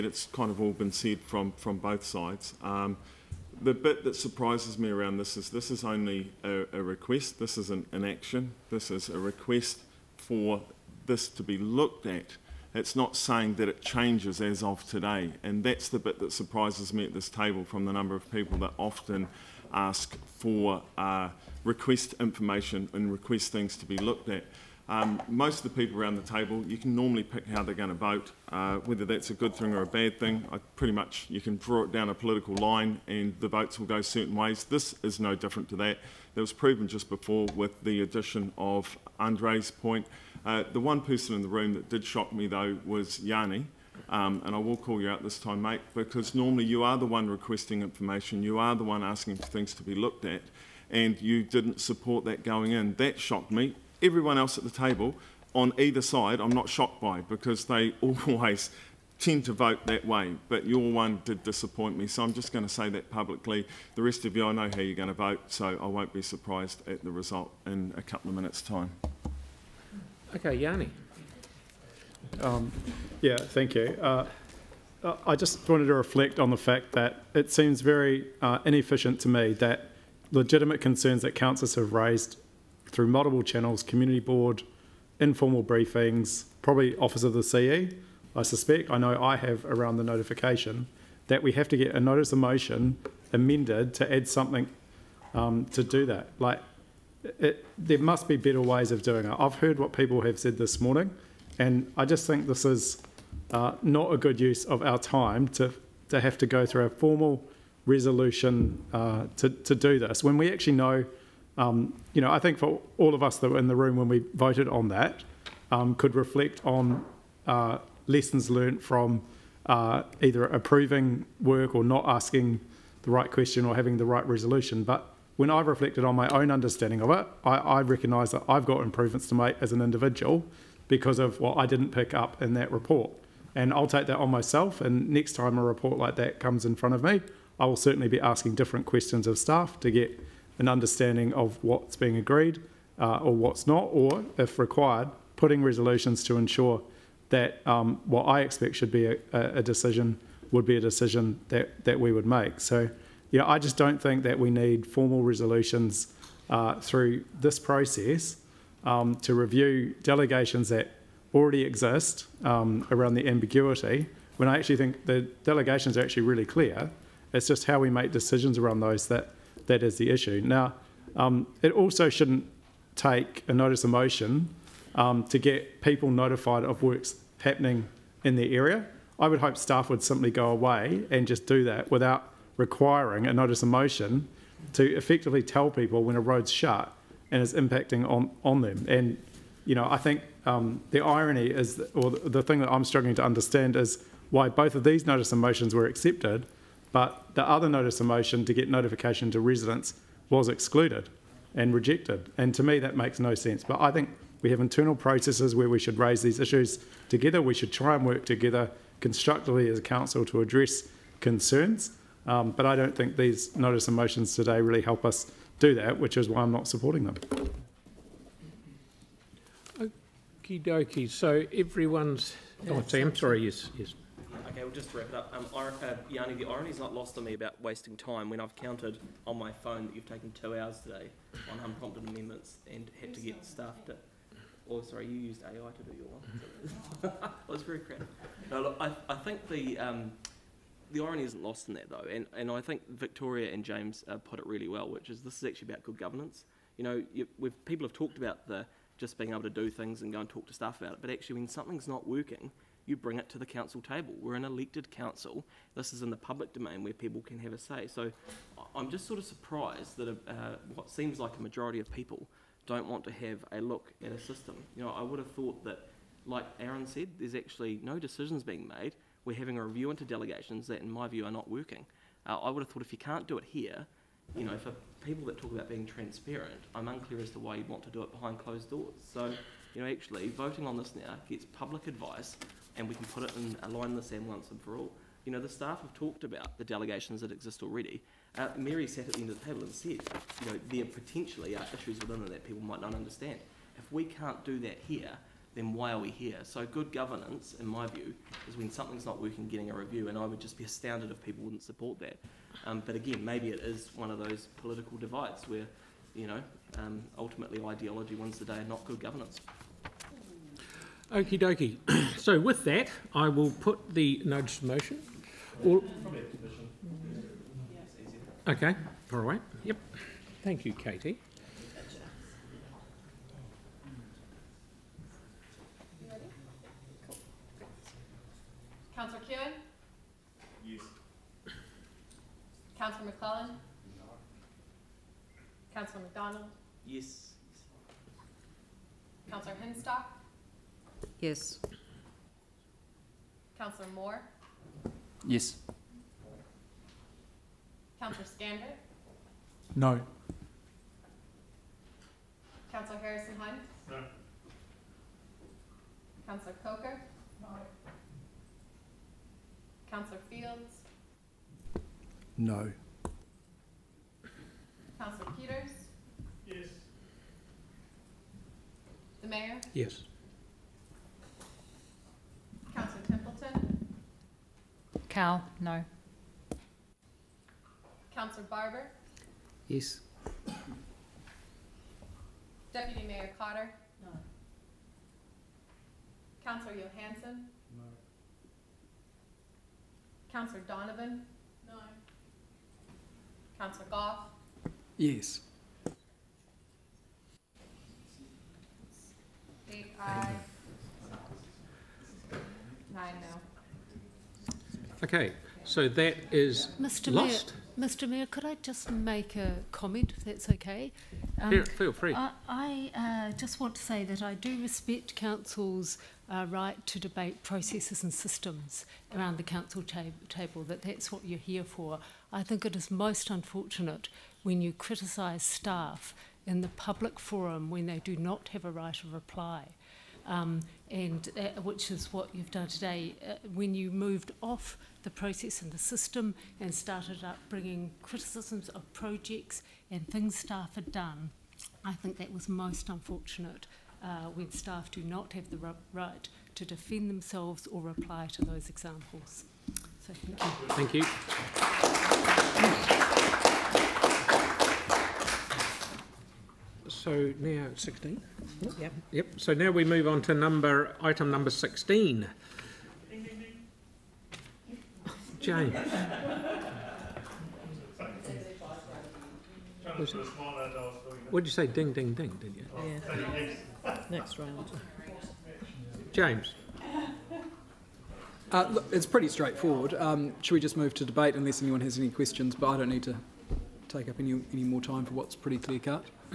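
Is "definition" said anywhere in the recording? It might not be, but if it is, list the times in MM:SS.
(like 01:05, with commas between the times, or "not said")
not said.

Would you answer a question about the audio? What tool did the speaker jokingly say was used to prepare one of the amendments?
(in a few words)
AI.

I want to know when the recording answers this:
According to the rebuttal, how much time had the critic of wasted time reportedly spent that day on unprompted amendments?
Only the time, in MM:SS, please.
03:50.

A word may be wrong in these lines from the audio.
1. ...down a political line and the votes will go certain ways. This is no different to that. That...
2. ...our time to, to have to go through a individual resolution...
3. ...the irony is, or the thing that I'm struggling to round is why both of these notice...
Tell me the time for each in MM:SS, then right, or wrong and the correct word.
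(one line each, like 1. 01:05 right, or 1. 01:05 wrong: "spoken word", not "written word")
1. 00:31 right
2. 01:44 wrong: "formal", not "individual"
3. 03:10 wrong: "understand", not "round".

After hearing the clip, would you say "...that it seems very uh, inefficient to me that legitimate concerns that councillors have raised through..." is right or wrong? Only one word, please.
right.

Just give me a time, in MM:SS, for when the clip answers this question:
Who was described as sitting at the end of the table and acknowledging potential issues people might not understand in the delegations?
04:48.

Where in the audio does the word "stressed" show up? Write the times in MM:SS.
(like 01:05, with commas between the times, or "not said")
not said.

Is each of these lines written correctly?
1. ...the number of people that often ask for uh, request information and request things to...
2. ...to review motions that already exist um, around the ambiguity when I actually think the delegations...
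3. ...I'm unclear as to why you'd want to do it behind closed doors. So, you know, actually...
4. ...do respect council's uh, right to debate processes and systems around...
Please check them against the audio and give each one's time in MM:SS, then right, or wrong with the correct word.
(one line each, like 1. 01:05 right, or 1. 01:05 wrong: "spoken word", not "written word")
1. 00:17 right
2. 02:39 wrong: "delegations", not "motions"
3. 04:36 right
4. 06:54 right.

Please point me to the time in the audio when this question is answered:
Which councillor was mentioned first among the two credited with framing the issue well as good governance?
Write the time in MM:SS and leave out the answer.
04:02.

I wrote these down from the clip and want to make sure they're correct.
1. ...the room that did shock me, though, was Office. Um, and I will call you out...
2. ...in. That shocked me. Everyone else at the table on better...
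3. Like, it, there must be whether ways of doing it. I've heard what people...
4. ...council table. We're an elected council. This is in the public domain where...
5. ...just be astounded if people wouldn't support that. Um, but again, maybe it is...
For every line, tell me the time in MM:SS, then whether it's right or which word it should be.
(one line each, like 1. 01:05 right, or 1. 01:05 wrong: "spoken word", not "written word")
1. 00:41 wrong: "Yani", not "Office"
2. 00:52 wrong: "either", not "better"
3. 01:36 wrong: "better", not "whether"
4. 04:13 right
5. 05:00 right.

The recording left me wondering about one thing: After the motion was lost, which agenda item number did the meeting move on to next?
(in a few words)
16.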